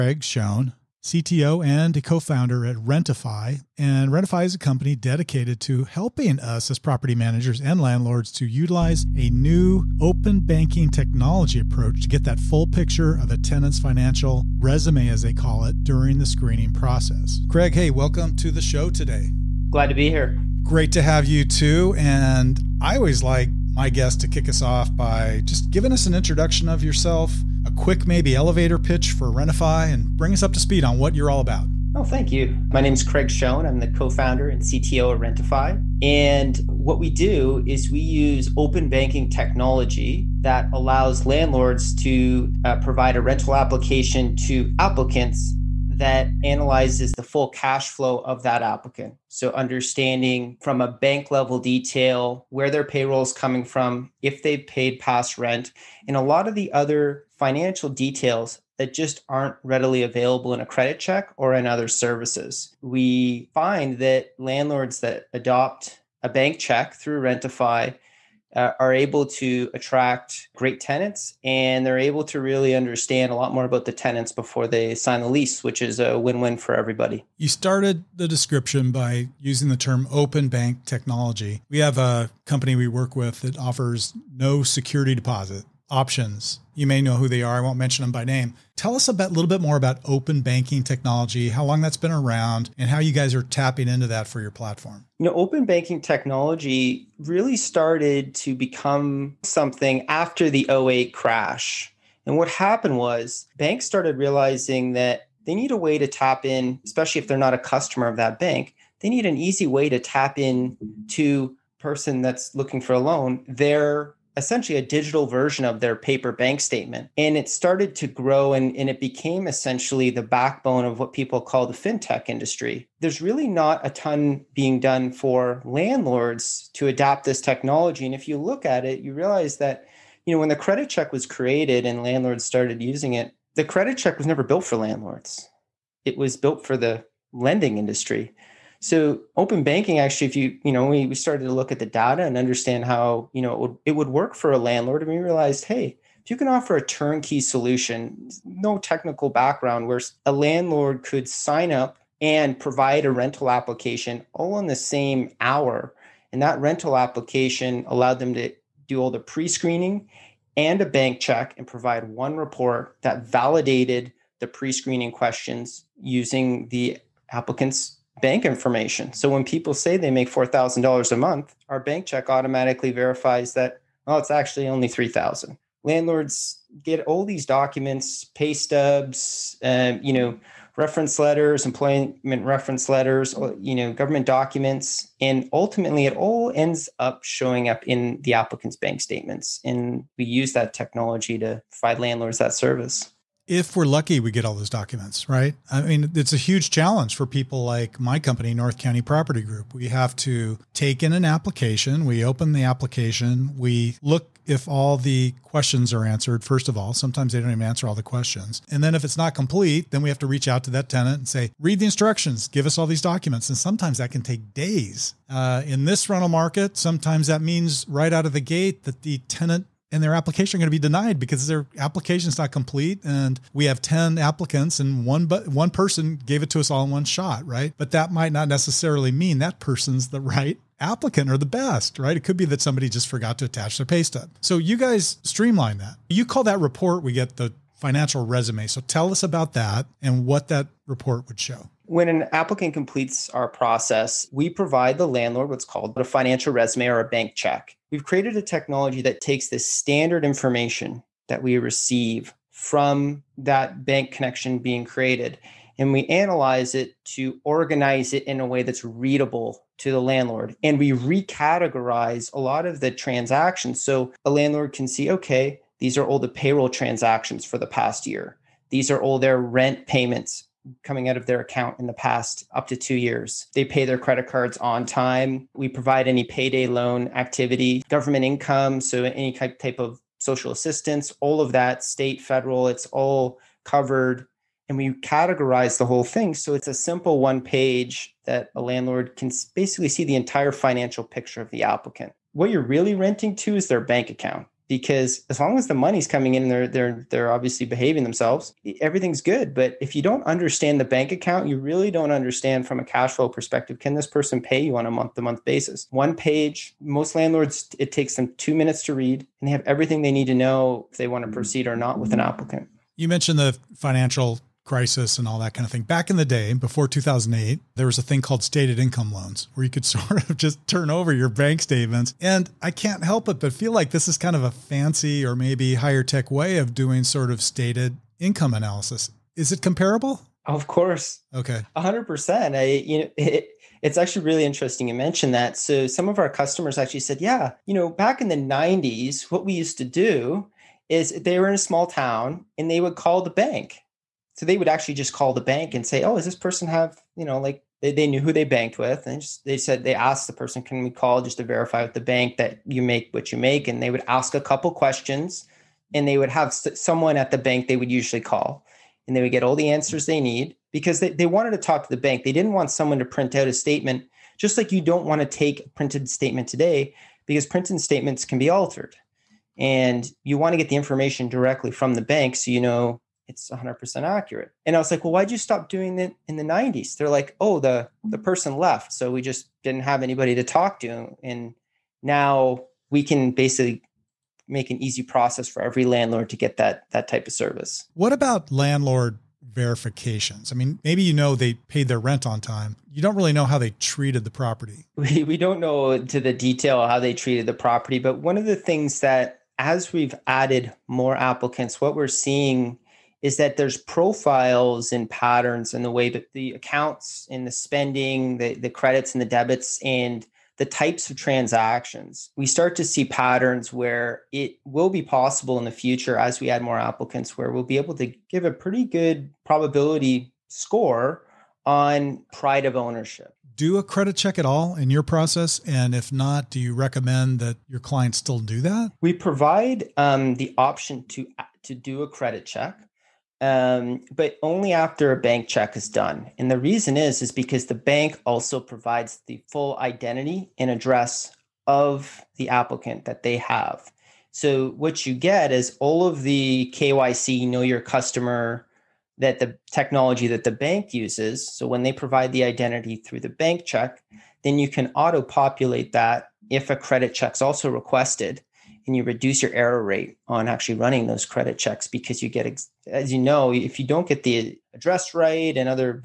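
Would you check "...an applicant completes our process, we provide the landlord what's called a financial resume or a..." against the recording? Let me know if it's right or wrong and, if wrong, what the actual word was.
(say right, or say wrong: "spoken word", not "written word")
right.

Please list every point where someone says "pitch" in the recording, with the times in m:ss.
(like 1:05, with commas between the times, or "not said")
0:28.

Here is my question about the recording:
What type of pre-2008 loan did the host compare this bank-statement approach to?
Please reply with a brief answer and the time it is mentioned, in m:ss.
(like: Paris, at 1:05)
stated income loans, at 5:18.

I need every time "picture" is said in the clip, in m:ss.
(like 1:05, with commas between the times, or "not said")
0:12, 4:51.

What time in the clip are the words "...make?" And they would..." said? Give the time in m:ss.
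5:53.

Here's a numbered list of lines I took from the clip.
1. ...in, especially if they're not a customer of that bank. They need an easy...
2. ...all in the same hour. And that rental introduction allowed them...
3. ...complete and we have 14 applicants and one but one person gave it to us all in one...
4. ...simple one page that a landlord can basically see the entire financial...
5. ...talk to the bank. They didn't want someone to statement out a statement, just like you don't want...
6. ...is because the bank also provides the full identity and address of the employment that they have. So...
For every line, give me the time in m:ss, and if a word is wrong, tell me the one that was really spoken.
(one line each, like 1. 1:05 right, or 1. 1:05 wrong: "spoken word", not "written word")
1. 1:46 right
2. 2:34 wrong: "application", not "introduction"
3. 3:42 wrong: "10", not "14"
4. 4:46 right
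5. 6:01 wrong: "print", not "statement"
6. 7:17 wrong: "applicant", not "employment".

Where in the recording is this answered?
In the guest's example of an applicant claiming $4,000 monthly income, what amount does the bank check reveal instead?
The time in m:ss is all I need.
2:54.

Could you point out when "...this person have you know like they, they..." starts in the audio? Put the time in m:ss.
5:46.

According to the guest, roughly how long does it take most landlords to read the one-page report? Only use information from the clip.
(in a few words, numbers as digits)
two minutes.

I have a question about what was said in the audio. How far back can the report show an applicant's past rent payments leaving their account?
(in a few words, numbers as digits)
two years.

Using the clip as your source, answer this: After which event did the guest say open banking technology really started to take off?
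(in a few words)
the 08 crash.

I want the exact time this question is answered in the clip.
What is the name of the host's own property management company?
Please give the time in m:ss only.
3:18.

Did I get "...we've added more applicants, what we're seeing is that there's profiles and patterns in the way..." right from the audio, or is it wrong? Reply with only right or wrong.
right.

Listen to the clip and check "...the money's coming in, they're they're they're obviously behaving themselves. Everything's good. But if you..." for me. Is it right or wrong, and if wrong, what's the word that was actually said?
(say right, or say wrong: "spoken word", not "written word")
right.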